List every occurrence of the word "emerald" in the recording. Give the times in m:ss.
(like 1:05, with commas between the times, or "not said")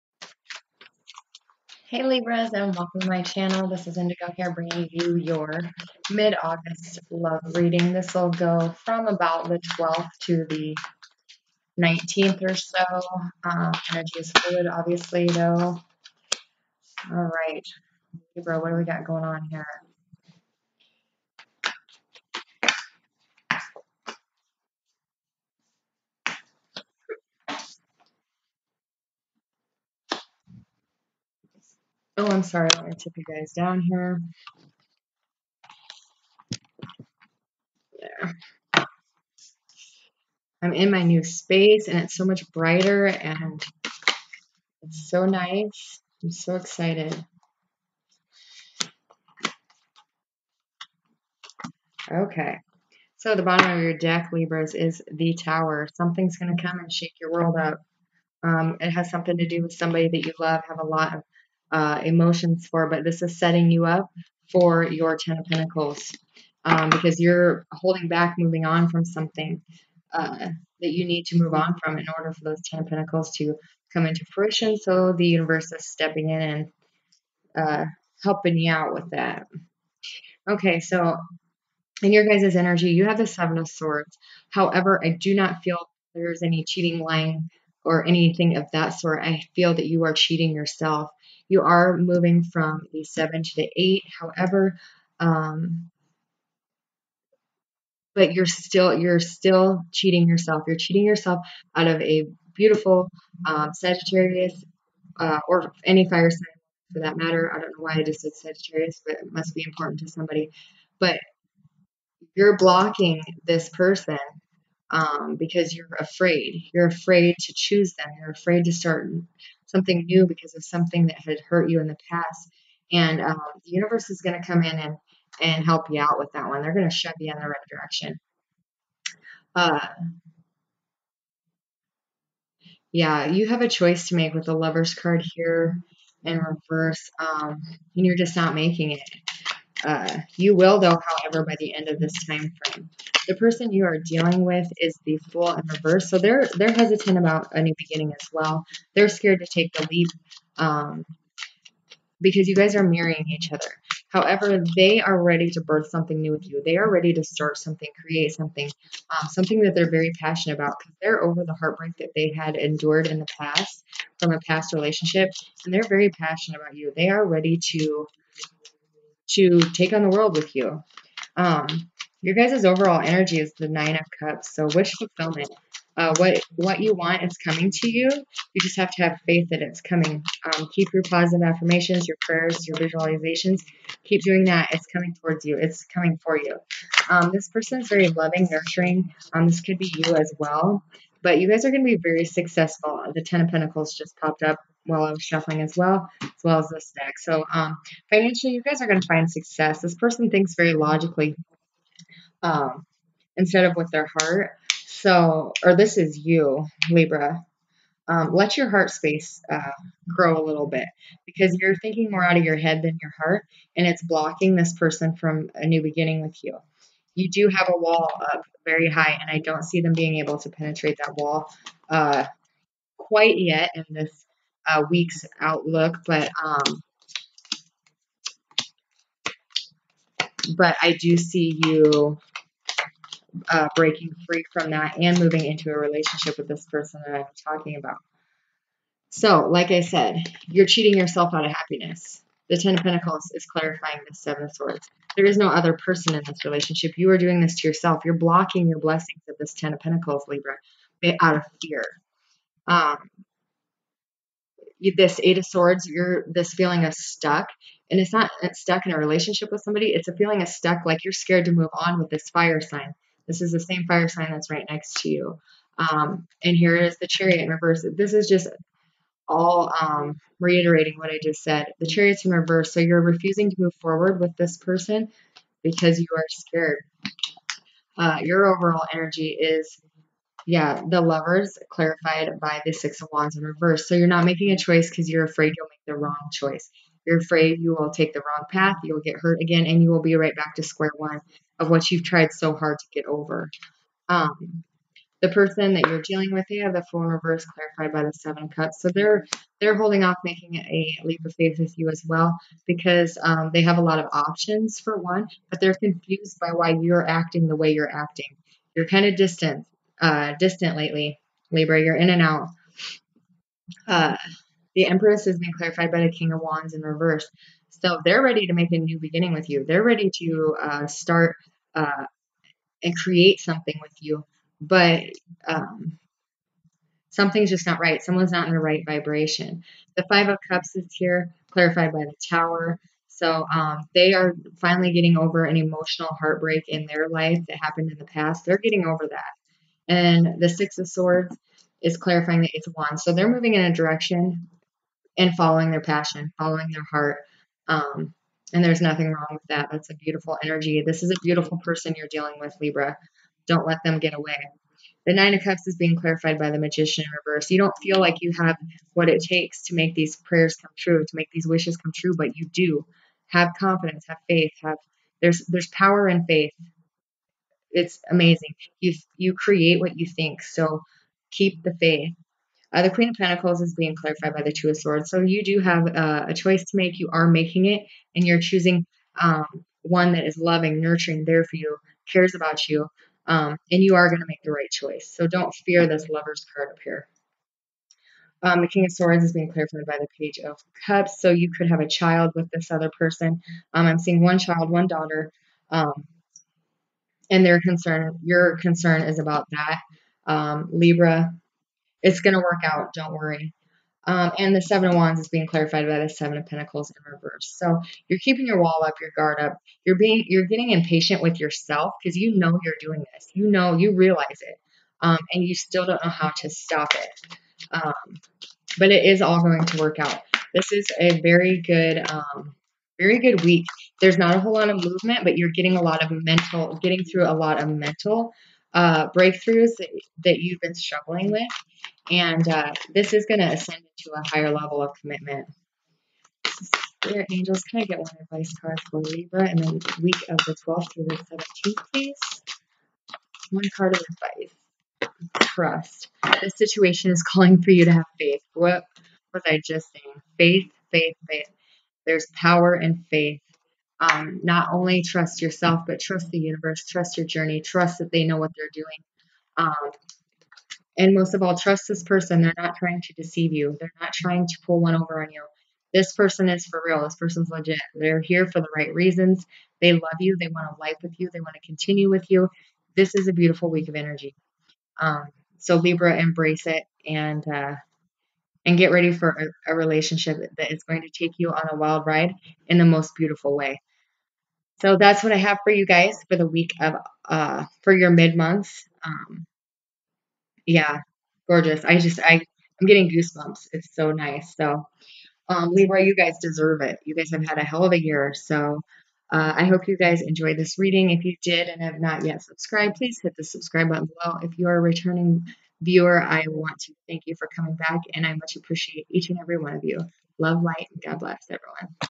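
not said.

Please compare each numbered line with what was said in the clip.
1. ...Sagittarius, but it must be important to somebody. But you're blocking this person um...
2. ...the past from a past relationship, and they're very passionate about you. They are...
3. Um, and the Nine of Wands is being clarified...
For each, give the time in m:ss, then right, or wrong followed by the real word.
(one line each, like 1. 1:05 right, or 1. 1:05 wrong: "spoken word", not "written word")
1. 1:48 right
2. 2:43 right
3. 6:44 wrong: "Seven", not "Nine".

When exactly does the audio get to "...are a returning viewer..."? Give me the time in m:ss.
8:24.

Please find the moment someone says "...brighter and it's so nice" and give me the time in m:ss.
0:42.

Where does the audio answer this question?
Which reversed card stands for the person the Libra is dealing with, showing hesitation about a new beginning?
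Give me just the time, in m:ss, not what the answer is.
2:25.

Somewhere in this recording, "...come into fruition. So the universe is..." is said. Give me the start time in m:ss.
1:13.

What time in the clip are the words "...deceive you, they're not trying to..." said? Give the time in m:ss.
7:43.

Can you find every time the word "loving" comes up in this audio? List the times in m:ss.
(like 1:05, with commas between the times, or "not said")
3:08, 6:20.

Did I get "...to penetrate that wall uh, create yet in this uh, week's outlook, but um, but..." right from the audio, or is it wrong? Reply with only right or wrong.
wrong.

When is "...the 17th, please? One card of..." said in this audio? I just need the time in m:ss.
7:21.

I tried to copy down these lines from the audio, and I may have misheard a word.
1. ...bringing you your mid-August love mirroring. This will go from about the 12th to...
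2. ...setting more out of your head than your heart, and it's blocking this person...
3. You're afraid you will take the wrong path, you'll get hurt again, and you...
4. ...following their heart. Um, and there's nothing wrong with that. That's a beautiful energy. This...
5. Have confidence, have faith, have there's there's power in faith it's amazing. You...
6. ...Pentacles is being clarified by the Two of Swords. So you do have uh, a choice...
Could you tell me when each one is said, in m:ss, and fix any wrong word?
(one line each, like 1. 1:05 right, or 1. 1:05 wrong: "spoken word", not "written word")
1. 0:04 wrong: "reading", not "mirroring"
2. 3:31 wrong: "thinking", not "setting"
3. 4:47 right
4. 5:46 right
5. 6:03 right
6. 6:13 right.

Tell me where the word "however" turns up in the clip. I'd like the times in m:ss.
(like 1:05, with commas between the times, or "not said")
1:24, 1:34, 2:21, 2:34.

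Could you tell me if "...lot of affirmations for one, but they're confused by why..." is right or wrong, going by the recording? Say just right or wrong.
wrong.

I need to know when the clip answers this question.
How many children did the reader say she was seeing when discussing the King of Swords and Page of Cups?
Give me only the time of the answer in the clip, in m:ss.
6:34.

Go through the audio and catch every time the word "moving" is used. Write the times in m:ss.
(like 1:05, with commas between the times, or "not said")
1:08, 1:31, 3:55, 5:43.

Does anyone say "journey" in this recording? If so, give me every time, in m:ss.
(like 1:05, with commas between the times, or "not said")
7:37.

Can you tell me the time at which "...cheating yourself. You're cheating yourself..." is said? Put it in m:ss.
1:39.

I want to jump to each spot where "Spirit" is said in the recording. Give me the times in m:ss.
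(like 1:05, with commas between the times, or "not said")
7:17.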